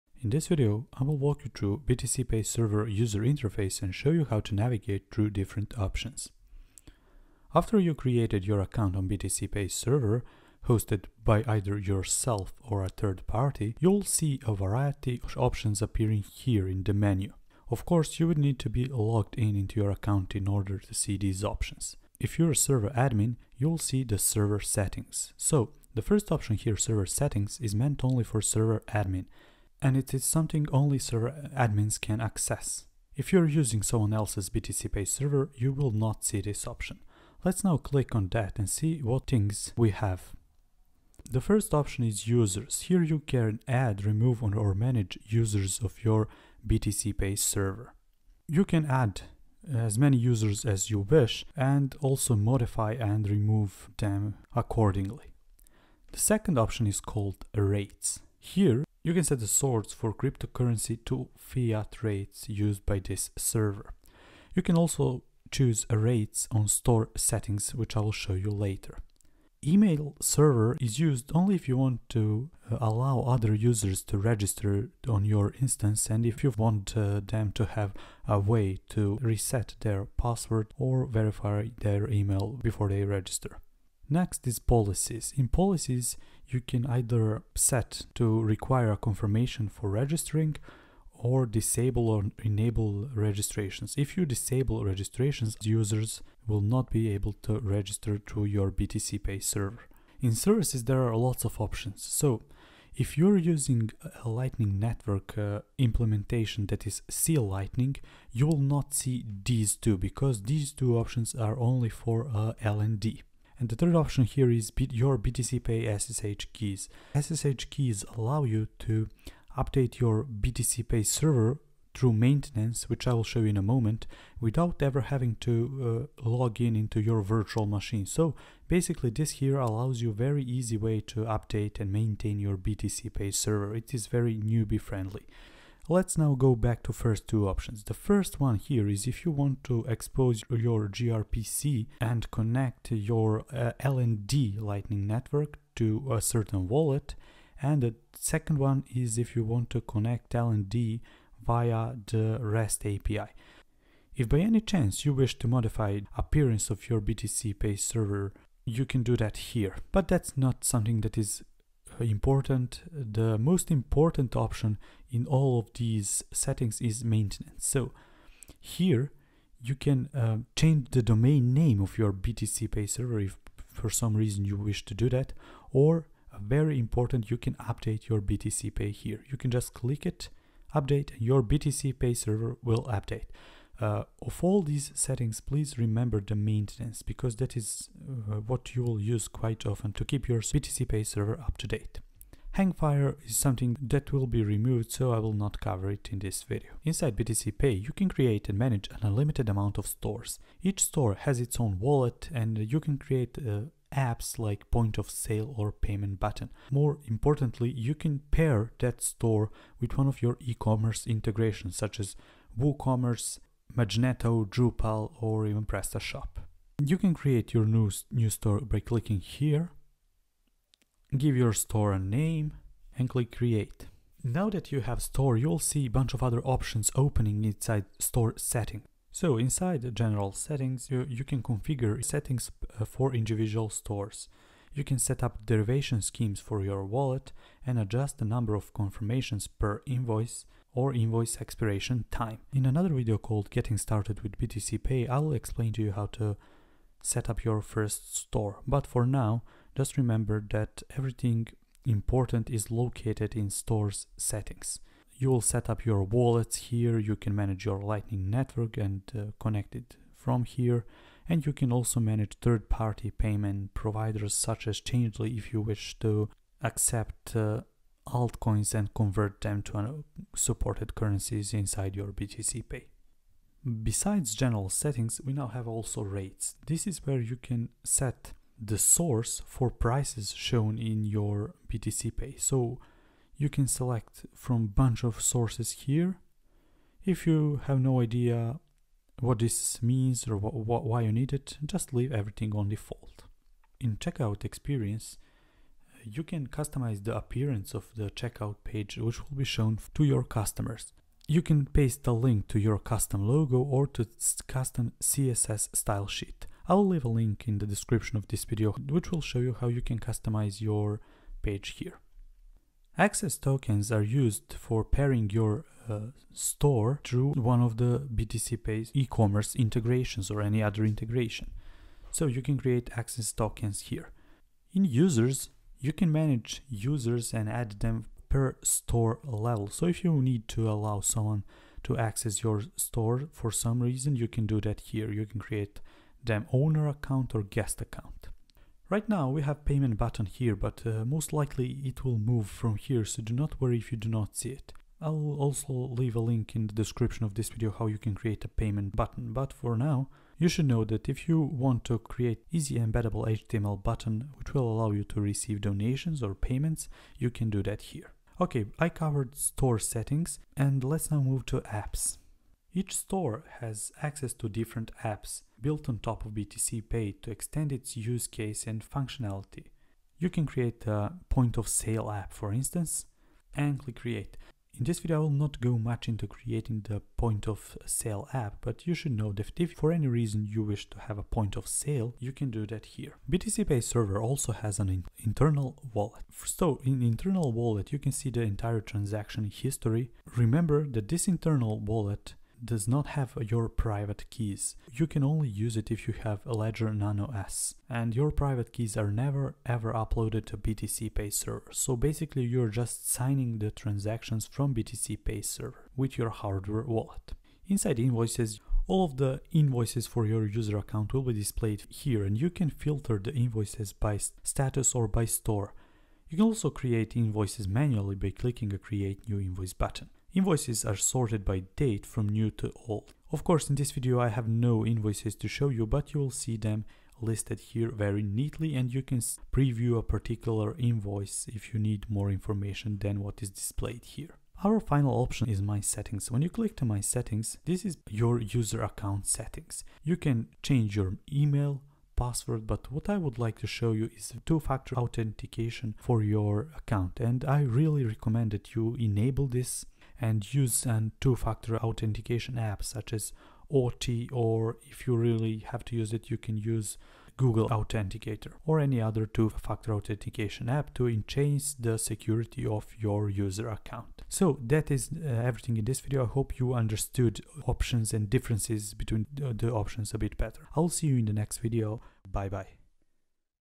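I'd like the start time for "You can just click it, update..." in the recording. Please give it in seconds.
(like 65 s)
179 s.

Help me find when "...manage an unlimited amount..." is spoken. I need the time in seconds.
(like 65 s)
198 s.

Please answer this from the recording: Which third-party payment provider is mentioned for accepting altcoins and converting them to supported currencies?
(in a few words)
Changelly.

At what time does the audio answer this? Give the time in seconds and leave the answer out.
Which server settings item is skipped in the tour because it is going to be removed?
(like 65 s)
192 s.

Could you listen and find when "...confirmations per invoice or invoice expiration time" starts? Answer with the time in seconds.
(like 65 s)
238 s.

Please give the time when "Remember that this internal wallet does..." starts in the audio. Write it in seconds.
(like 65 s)
390 s.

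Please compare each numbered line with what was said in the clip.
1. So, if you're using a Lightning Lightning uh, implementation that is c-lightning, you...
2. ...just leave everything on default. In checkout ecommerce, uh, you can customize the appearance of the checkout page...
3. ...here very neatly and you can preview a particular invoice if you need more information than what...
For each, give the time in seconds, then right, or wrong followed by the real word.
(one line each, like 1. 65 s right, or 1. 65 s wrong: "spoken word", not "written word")
1. 102 s wrong: "Network", not "Lightning"
2. 291 s wrong: "experience", not "ecommerce"
3. 427 s right.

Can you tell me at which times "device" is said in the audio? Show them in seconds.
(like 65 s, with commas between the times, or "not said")
not said.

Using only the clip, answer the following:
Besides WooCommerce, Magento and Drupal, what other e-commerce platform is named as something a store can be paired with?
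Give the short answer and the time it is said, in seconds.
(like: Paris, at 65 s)
PrestaShop, at 215 s.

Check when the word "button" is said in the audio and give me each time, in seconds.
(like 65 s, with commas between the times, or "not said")
206 s, 339 s, 348 s, 353 s, 419 s.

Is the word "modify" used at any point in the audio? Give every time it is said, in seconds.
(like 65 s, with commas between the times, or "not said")
52 s, 155 s.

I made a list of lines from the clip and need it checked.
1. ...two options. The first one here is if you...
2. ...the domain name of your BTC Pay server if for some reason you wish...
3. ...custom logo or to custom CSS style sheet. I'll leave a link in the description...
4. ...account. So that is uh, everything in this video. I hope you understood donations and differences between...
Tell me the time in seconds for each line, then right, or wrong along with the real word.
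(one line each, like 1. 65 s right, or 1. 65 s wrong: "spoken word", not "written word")
1. 137 s right
2. 170 s right
3. 302 s right
4. 463 s wrong: "options", not "donations".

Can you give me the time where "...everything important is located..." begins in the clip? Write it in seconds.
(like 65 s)
250 s.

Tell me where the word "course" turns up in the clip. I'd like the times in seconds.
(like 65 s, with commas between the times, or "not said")
17 s, 423 s.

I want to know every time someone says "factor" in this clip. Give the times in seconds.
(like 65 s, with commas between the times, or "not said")
444 s, 451 s, 459 s.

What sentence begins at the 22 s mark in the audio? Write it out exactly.
If you're a server admin, you'll see the server settings.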